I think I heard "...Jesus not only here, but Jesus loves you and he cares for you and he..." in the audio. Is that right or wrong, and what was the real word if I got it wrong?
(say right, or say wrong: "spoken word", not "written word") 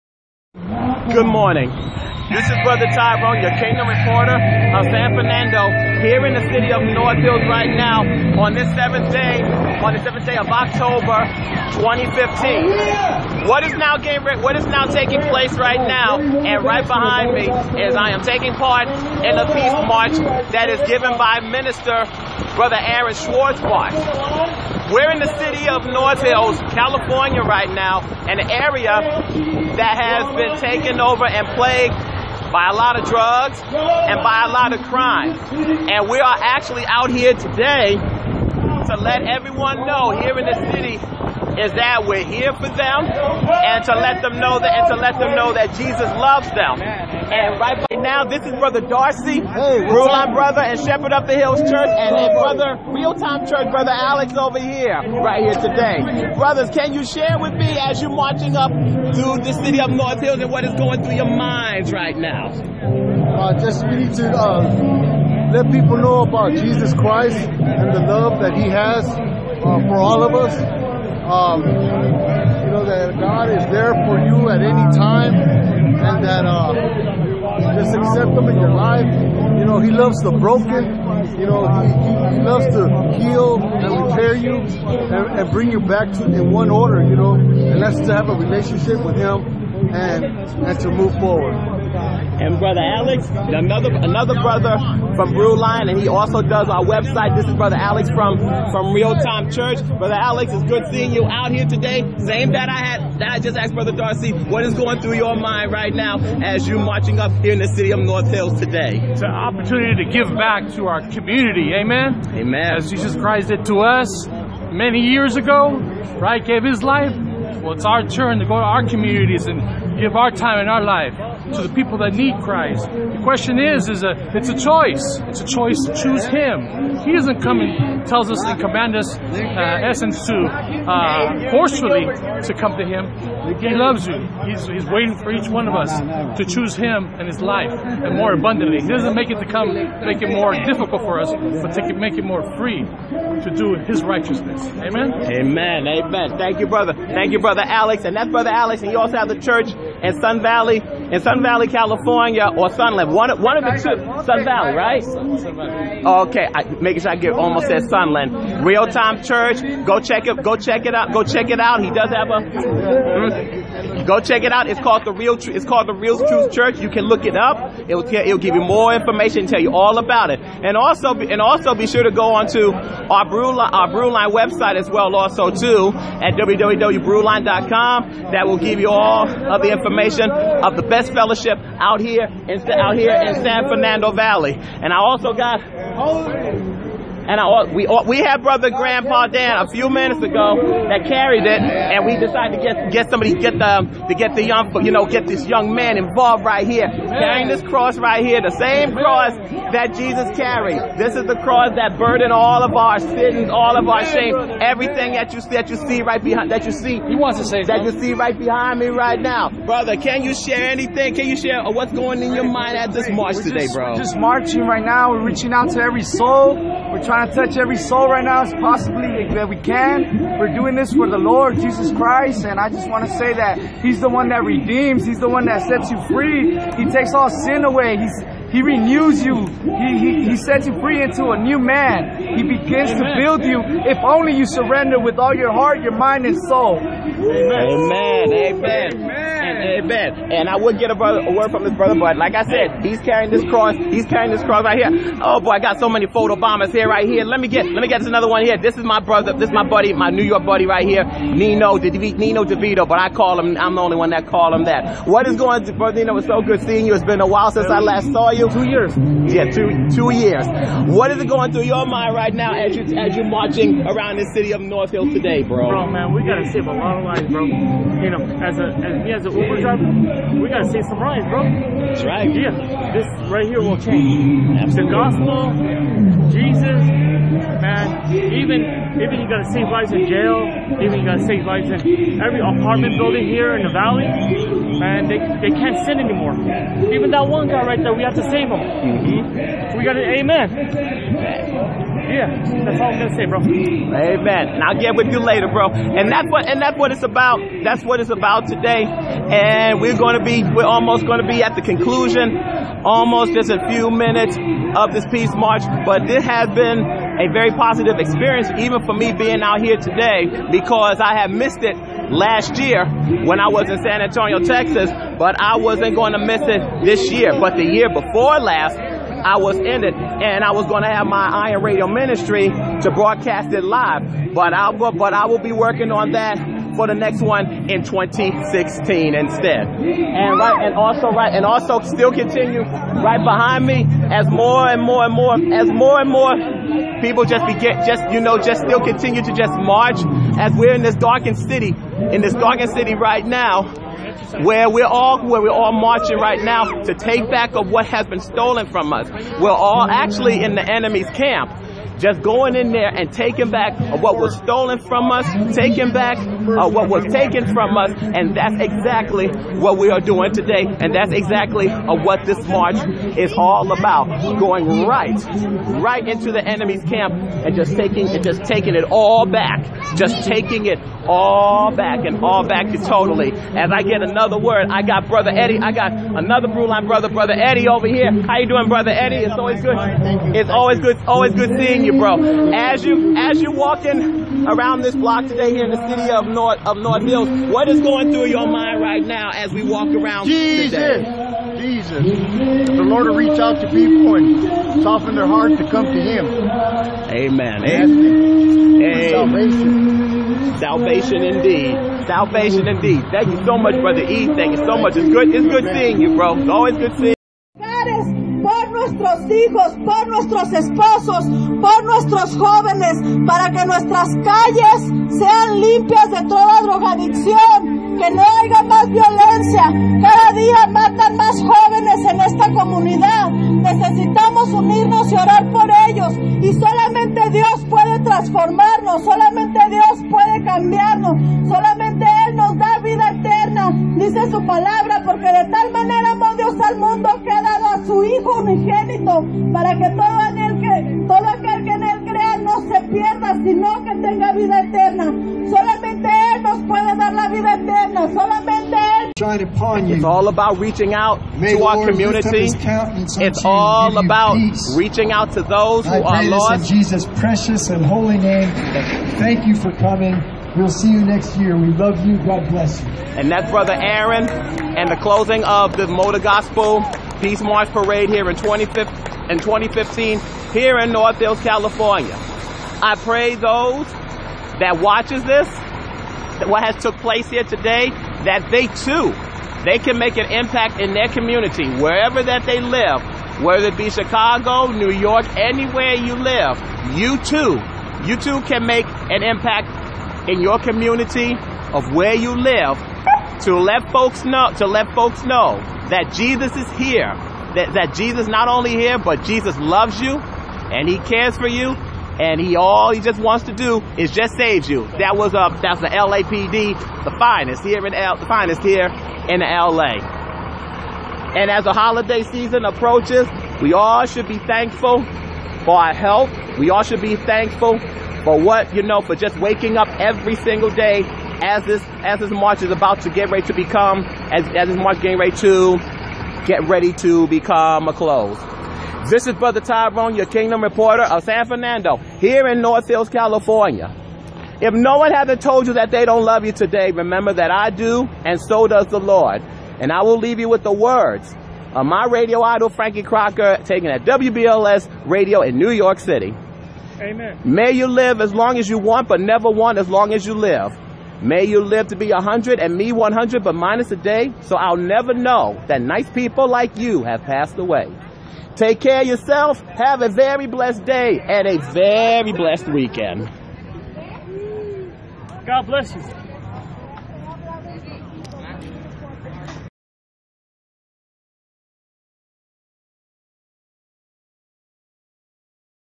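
right.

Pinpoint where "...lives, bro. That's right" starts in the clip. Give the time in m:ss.
4:30.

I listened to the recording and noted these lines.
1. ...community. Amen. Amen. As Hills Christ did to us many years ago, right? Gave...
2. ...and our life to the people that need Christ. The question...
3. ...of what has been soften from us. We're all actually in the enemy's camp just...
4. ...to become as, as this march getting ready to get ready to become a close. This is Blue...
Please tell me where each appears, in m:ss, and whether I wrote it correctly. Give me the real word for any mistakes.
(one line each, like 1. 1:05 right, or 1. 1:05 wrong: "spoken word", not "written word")
1. 1:51 wrong: "Jesus", not "Hills"
2. 2:00 right
3. 5:47 wrong: "stolen", not "soften"
4. 8:43 wrong: "Brother", not "Blue".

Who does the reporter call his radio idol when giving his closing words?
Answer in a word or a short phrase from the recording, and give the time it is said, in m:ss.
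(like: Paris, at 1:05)
Frankie Crocker, at 9:02.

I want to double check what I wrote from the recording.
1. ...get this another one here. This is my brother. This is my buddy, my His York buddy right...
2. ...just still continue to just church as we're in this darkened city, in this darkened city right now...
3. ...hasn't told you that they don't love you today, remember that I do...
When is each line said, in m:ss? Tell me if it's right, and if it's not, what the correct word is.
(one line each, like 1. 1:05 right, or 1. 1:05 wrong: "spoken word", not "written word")
1. 4:07 wrong: "New", not "His"
2. 5:38 wrong: "march", not "church"
3. 8:55 right.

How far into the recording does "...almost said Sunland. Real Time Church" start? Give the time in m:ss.
2:37.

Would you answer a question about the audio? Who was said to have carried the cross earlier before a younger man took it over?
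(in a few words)
Grandpa Dan.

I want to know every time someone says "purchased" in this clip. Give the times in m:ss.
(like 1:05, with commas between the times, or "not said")
not said.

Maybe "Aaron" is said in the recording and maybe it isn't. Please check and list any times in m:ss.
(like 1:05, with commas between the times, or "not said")
0:22, 7:43.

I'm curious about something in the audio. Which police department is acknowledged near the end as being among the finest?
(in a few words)
LAPD.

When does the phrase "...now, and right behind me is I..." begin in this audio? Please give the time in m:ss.
0:15.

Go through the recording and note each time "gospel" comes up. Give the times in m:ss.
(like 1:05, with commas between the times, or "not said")
4:34, 7:46.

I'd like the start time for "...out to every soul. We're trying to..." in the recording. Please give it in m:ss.
3:35.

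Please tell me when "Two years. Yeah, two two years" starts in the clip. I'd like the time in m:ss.
4:18.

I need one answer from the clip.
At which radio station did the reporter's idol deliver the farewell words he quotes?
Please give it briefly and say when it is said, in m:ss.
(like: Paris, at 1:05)
WBLS, at 9:04.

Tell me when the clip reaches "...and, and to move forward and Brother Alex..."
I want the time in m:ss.
1:29.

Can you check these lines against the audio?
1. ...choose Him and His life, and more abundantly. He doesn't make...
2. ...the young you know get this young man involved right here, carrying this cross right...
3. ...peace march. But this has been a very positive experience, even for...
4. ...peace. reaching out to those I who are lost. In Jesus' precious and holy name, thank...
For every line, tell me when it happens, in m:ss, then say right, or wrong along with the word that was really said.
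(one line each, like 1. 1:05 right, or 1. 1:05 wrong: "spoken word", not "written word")
1. 2:16 right
2. 3:14 right
3. 5:05 right
4. 7:34 right.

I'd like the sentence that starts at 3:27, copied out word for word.
He wants to say that you see right behind me right now, brother.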